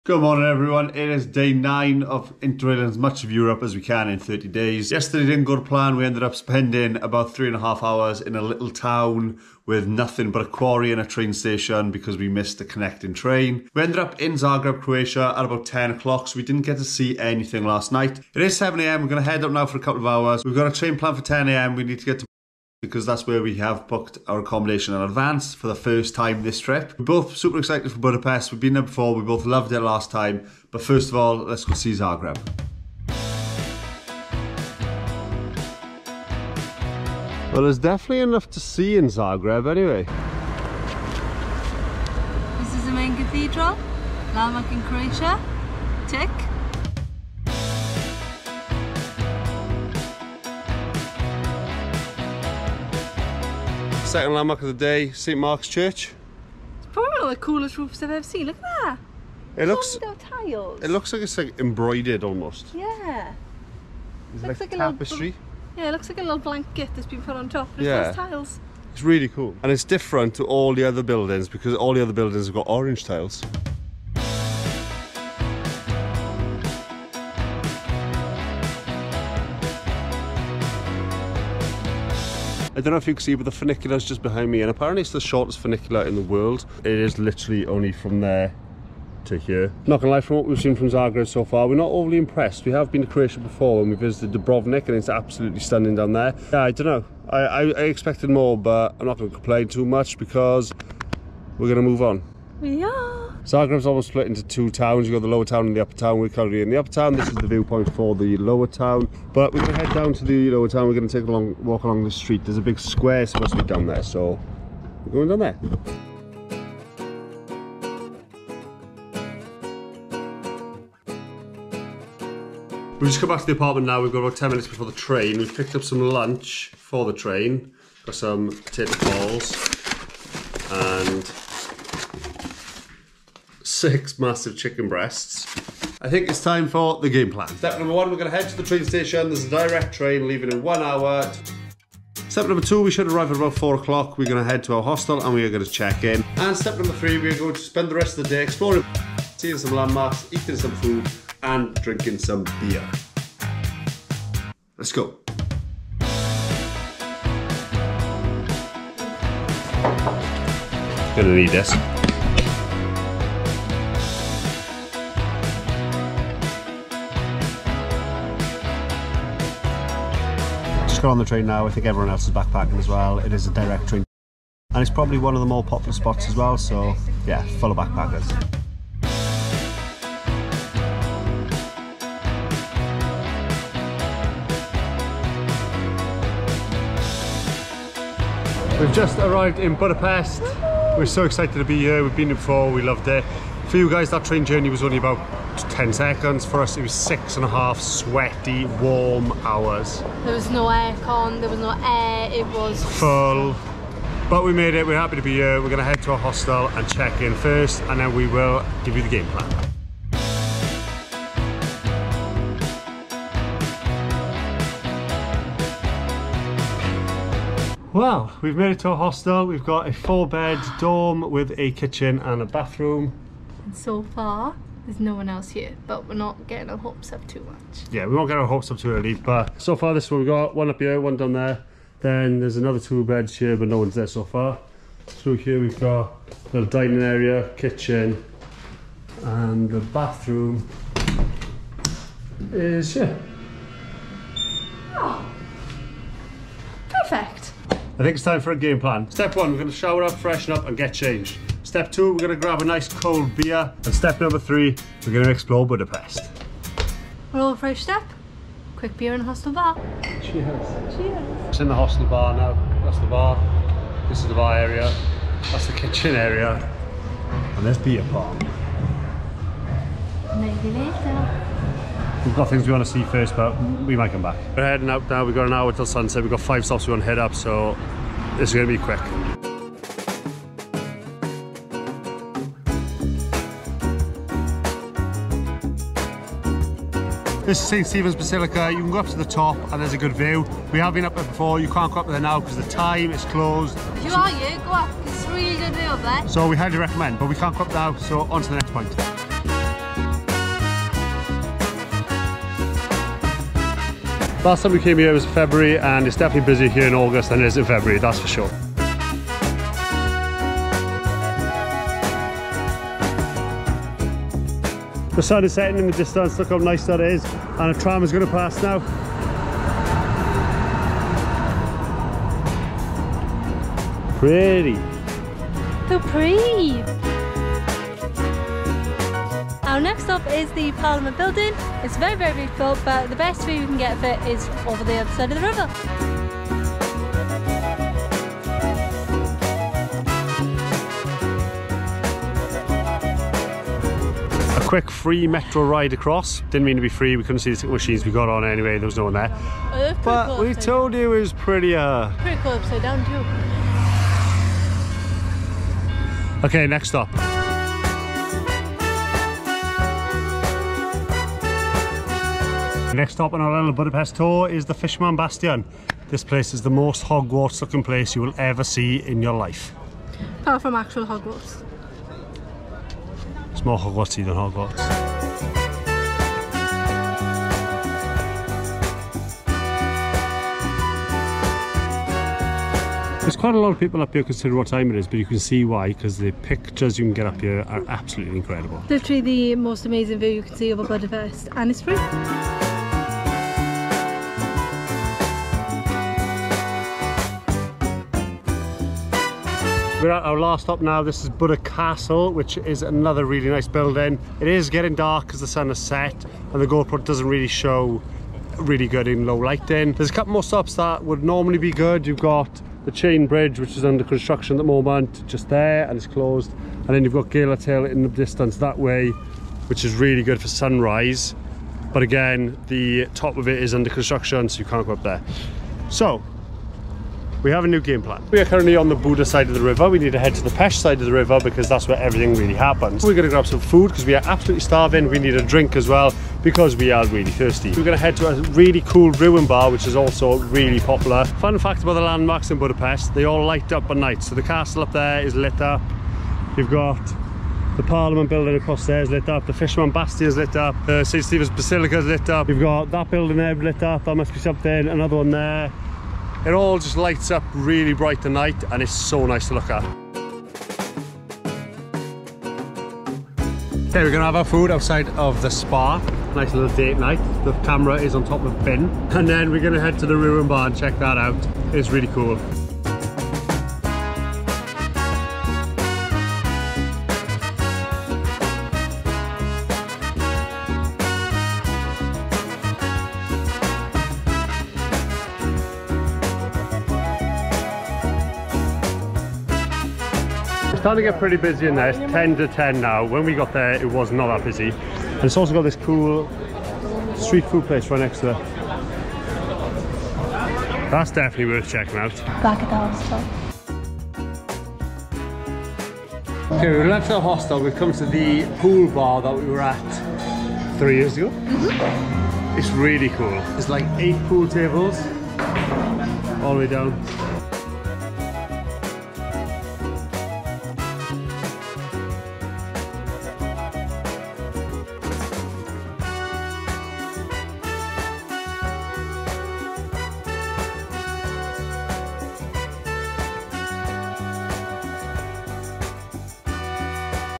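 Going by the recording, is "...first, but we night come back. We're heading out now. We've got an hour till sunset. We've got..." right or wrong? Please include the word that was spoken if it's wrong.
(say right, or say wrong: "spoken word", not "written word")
wrong: "might", not "night".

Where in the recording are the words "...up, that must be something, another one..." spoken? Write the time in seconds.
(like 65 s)
453 s.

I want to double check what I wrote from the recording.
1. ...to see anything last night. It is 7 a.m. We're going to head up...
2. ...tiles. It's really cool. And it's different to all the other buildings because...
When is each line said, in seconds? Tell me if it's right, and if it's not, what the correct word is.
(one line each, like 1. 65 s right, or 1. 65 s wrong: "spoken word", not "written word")
1. 16 s right
2. 68 s right.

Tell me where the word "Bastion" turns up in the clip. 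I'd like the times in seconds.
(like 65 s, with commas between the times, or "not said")
365 s, 449 s.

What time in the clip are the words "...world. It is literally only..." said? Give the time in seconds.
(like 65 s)
86 s.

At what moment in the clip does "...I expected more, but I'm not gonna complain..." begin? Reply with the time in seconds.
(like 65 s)
97 s.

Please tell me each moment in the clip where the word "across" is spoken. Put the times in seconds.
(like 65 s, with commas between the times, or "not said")
345 s, 448 s.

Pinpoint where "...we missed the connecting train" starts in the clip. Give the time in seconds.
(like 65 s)
12 s.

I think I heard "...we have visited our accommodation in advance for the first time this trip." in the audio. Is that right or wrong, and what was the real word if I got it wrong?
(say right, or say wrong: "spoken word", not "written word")
wrong: "booked", not "visited".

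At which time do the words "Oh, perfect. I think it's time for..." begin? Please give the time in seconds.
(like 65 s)
244 s.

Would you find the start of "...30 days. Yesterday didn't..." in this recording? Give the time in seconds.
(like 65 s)
4 s.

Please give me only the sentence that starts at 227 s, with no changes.
Yeah, we won't get our hopes up too early.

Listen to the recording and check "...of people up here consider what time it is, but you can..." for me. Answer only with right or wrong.
right.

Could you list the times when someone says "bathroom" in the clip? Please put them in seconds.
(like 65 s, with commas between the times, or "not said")
222 s, 239 s.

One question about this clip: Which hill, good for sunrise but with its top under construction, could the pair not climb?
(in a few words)
Gellert Hill.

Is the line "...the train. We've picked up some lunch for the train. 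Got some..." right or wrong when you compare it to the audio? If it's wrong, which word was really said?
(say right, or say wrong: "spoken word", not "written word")
right.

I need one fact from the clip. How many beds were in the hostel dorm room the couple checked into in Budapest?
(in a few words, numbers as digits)
4.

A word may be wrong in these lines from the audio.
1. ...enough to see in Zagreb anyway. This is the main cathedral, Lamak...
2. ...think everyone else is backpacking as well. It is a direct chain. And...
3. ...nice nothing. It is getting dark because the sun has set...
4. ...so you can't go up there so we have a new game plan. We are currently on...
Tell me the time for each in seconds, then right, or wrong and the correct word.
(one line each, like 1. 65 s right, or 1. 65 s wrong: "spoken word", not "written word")
1. 38 s right
2. 171 s wrong: "train", not "chain"
3. 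403 s wrong: "building", not "nothing"
4. 424 s right.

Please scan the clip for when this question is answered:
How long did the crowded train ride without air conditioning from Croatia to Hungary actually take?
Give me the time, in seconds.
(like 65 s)
196 s.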